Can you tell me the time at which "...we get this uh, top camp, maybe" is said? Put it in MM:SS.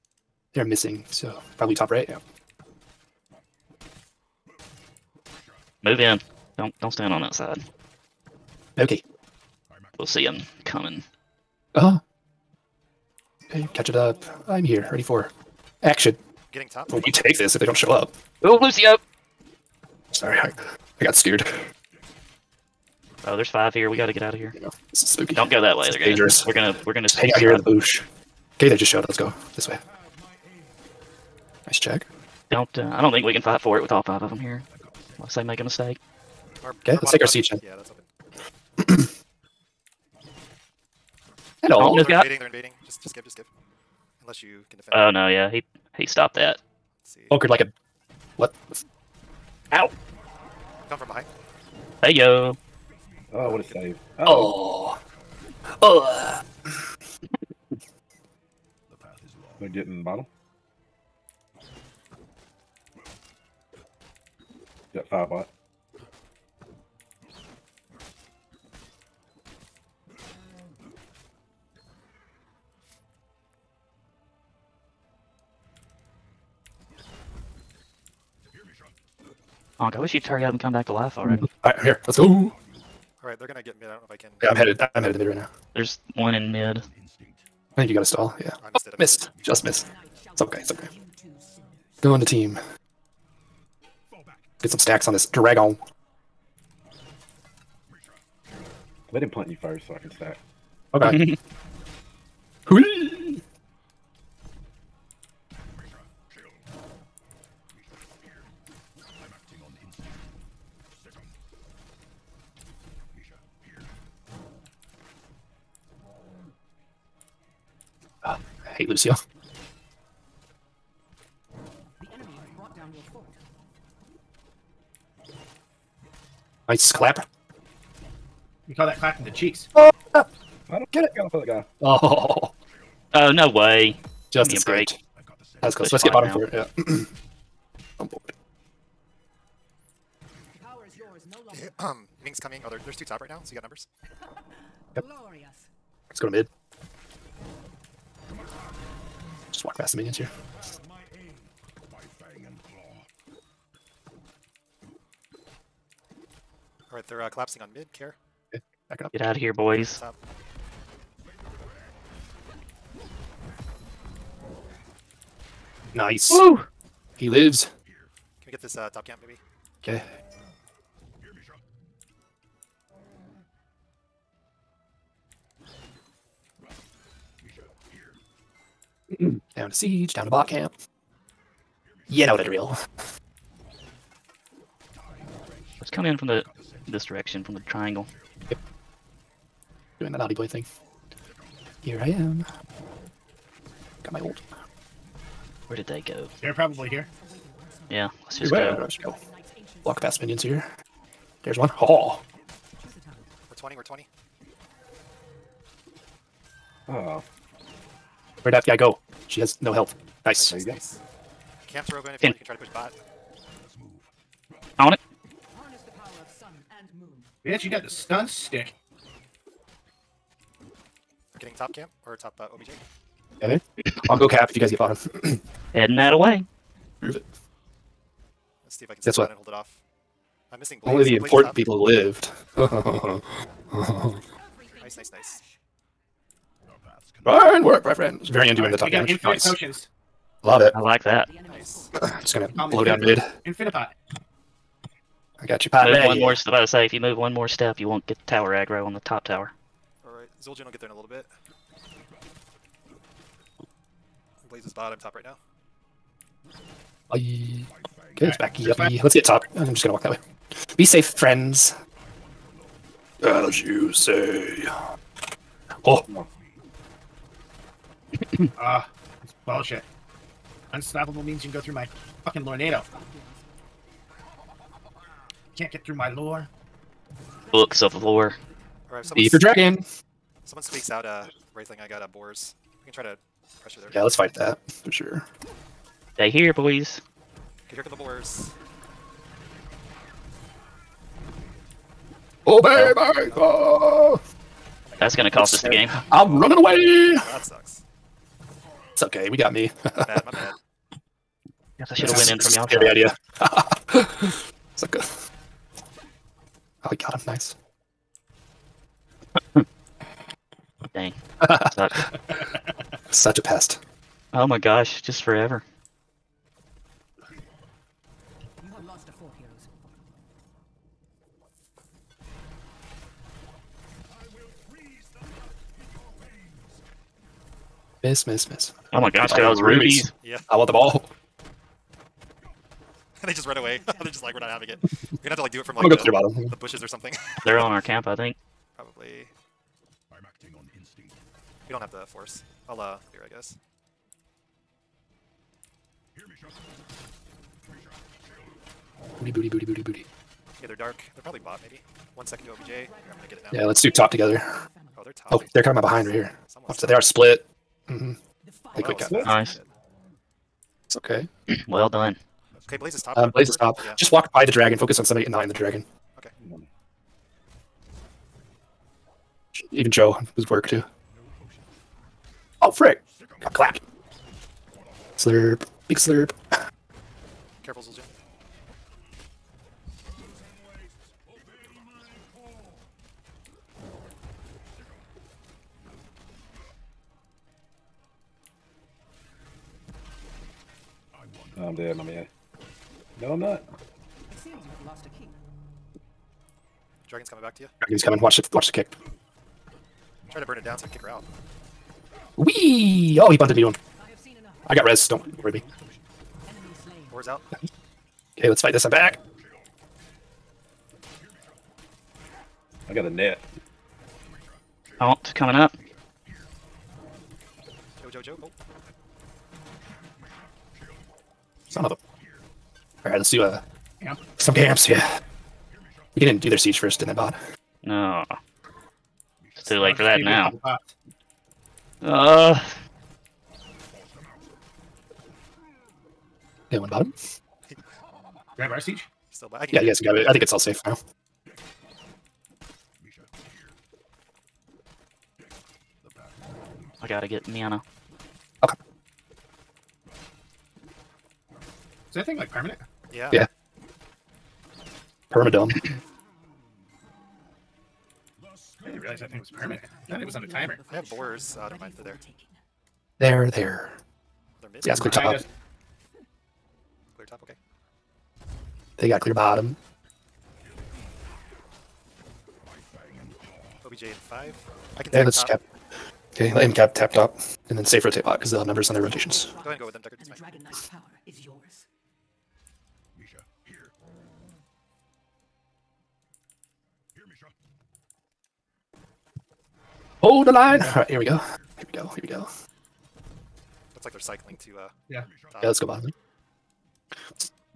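02:48.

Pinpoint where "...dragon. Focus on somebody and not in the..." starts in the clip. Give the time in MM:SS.
06:04.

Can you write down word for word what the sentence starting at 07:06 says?
We can do their siege first and then bot.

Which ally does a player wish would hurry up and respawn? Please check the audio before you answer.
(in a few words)
Anka.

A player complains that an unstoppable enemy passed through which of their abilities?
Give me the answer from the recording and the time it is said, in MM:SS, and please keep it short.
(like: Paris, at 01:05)
tornado, at 04:32.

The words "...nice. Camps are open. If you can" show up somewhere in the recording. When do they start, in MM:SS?
03:30.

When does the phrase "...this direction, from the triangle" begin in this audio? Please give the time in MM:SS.
03:06.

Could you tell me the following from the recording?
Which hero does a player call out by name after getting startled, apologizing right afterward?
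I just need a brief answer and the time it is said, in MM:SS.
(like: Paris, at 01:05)
Lucio, at 00:18.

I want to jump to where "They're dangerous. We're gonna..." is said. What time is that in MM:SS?
00:25.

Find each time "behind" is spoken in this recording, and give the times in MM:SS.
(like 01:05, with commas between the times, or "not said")
00:51, 05:55.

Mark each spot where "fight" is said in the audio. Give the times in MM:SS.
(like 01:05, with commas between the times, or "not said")
00:33, 04:44, 06:48.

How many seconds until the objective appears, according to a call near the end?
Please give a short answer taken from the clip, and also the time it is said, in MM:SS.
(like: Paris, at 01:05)
5, at 07:53.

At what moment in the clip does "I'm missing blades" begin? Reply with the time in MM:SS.
03:50.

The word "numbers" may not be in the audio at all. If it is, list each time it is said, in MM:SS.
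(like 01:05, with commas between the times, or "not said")
02:23, 07:58.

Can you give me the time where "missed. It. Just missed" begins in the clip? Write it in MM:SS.
01:29.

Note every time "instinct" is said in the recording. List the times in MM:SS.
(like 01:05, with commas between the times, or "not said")
05:40.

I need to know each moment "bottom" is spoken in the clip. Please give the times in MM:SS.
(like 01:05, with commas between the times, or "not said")
01:00, 02:16, 03:44, 05:36, 07:16, 07:49, 08:15.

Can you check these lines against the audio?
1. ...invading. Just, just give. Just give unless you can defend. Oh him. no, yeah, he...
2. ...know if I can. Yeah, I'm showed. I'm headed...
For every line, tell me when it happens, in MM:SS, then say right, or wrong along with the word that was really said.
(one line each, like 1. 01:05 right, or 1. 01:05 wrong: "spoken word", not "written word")
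1. 00:42 right
2. 01:24 wrong: "headed", not "showed".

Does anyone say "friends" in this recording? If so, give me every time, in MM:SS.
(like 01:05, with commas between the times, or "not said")
03:57, 04:21.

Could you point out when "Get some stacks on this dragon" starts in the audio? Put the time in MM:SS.
01:34.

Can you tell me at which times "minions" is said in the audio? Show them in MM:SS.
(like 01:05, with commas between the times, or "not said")
02:29, 03:20.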